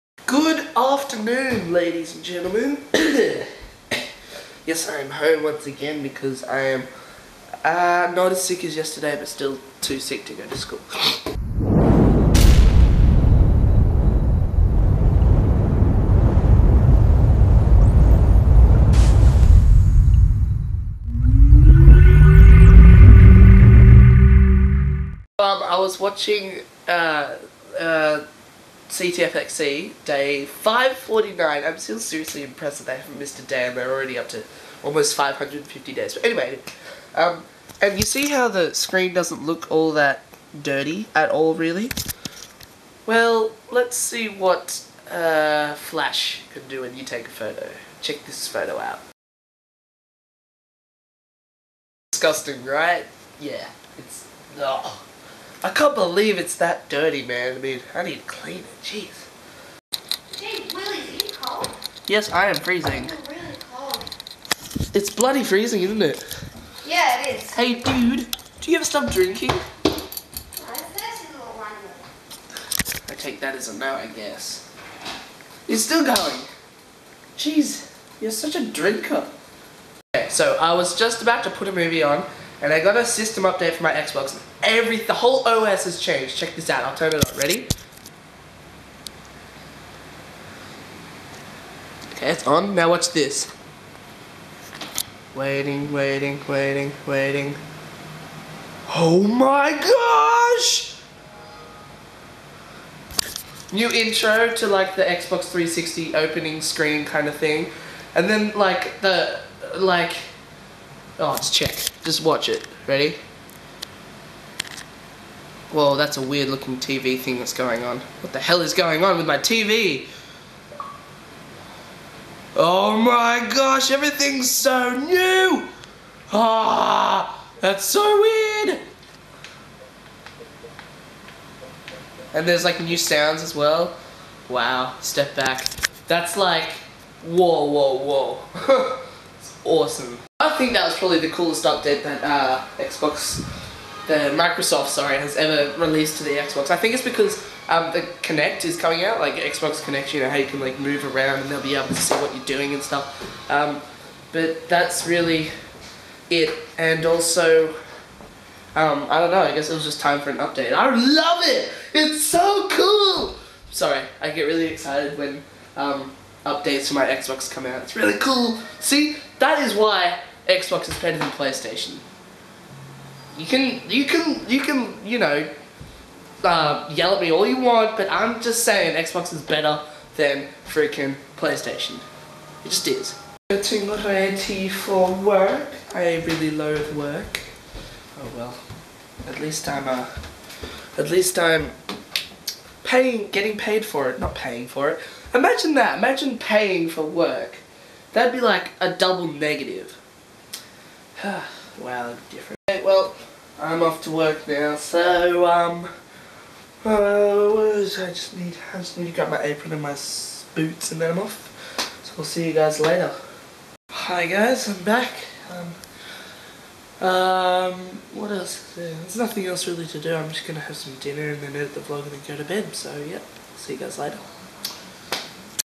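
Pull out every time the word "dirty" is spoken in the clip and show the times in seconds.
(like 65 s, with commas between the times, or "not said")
40 s, 56 s.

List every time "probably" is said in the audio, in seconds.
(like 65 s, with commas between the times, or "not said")
140 s.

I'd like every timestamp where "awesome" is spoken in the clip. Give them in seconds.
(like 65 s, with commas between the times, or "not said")
139 s.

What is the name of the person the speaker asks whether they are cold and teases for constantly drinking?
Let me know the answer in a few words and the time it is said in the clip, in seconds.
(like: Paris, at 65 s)
Willie, at 60 s.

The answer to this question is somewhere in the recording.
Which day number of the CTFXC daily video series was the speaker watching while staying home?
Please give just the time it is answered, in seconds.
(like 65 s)
30 s.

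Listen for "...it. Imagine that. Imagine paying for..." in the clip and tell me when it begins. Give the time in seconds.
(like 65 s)
194 s.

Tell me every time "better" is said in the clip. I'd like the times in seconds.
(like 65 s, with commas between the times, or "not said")
170 s, 179 s.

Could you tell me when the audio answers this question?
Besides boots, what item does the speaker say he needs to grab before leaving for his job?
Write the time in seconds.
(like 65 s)
209 s.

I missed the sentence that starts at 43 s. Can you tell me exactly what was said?
Well, let's see what uh, Flash can do when you take a photo.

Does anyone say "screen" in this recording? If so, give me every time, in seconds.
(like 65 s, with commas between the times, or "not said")
38 s, 106 s.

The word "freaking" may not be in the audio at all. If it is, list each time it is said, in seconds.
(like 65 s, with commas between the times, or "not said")
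180 s.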